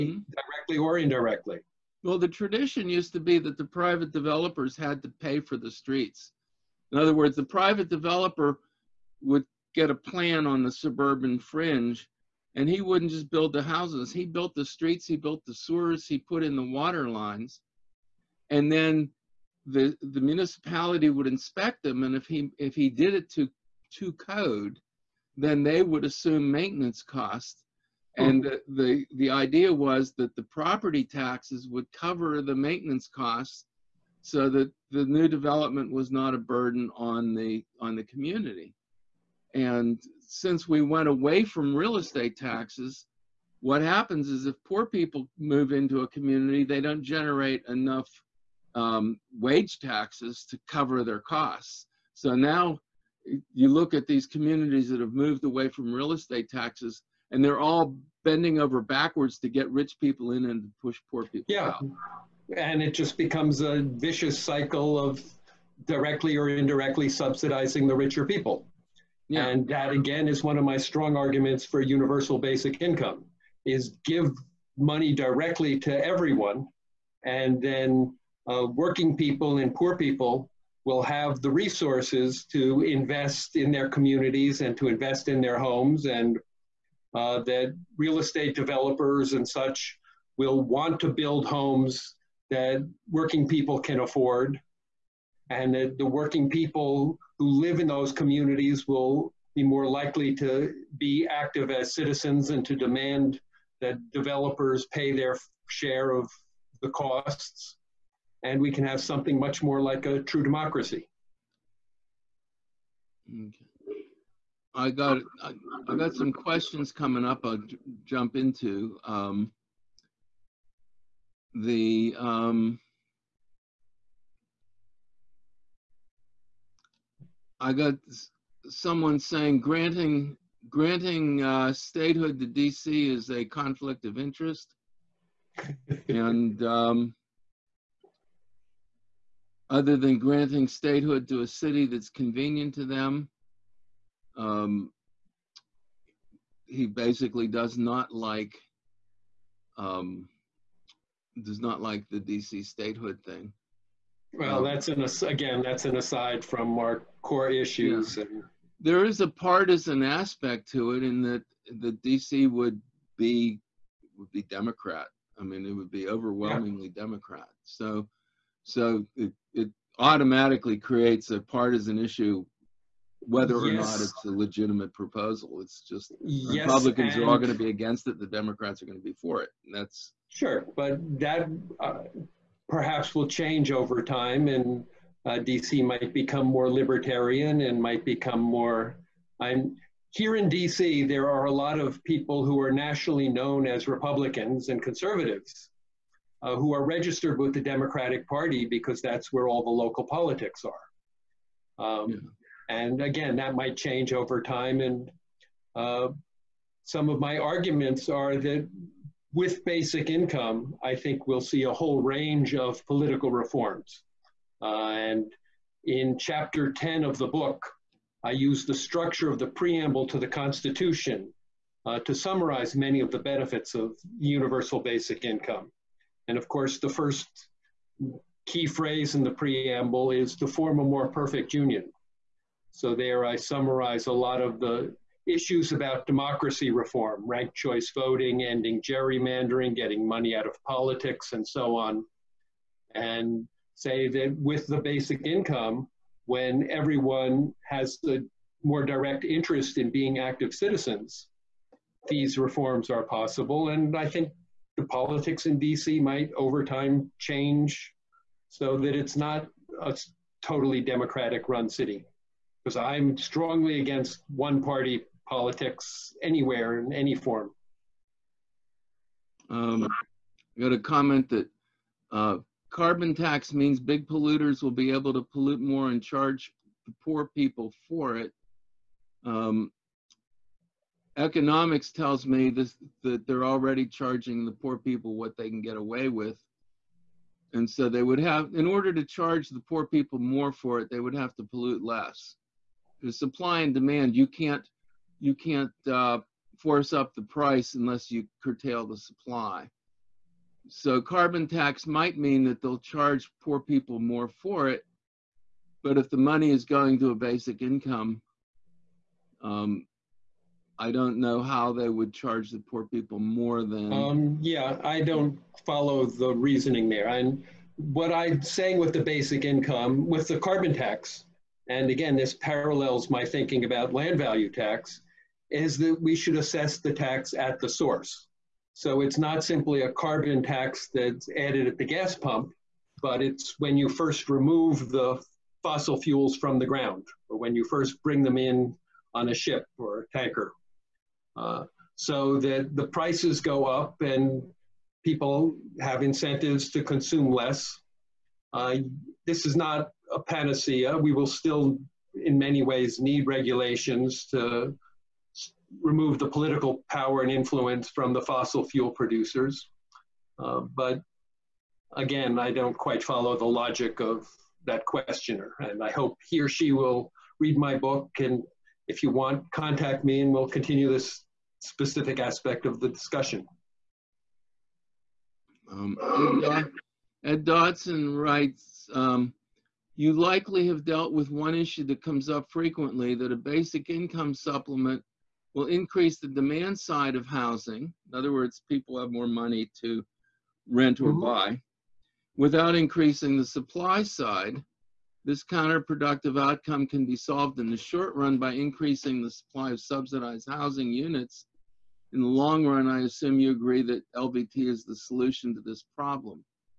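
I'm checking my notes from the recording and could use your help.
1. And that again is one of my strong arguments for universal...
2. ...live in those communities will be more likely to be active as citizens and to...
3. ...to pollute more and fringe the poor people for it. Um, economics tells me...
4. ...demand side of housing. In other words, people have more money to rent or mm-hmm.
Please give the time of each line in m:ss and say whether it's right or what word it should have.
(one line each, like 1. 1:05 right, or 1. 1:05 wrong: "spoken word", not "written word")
1. 1:09 right
2. 1:37 right
3. 4:35 wrong: "charge", not "fringe"
4. 6:26 right.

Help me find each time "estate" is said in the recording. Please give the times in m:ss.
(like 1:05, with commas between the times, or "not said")
0:41, 0:56, 1:28.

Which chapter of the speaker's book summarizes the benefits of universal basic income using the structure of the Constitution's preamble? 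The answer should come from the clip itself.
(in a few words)
Chapter 10.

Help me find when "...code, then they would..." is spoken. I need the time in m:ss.
0:24.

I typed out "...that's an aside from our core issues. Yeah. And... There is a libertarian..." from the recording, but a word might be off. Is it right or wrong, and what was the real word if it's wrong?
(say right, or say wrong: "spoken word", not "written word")
wrong: "partisan", not "libertarian".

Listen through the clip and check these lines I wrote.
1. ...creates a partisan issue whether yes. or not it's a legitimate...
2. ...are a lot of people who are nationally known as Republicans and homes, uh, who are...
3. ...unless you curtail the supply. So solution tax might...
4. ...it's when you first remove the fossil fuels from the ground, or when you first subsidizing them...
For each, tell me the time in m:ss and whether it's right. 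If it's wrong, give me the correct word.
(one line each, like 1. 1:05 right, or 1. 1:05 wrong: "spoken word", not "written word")
1. 2:50 right
2. 3:11 wrong: "conservatives", not "homes"
3. 4:57 wrong: "carbon", not "solution"
4. 5:33 wrong: "bring", not "subsidizing".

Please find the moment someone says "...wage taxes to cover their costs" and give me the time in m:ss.
0:49.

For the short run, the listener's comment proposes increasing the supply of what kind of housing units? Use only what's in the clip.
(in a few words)
Subsidized housing.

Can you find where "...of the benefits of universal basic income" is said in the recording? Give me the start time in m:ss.
3:43.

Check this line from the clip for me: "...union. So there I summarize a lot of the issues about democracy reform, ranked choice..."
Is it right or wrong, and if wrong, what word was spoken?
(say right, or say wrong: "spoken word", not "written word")
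right.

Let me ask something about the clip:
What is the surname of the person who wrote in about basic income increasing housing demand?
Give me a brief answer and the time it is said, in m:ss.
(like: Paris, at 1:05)
Dodson, at 6:17.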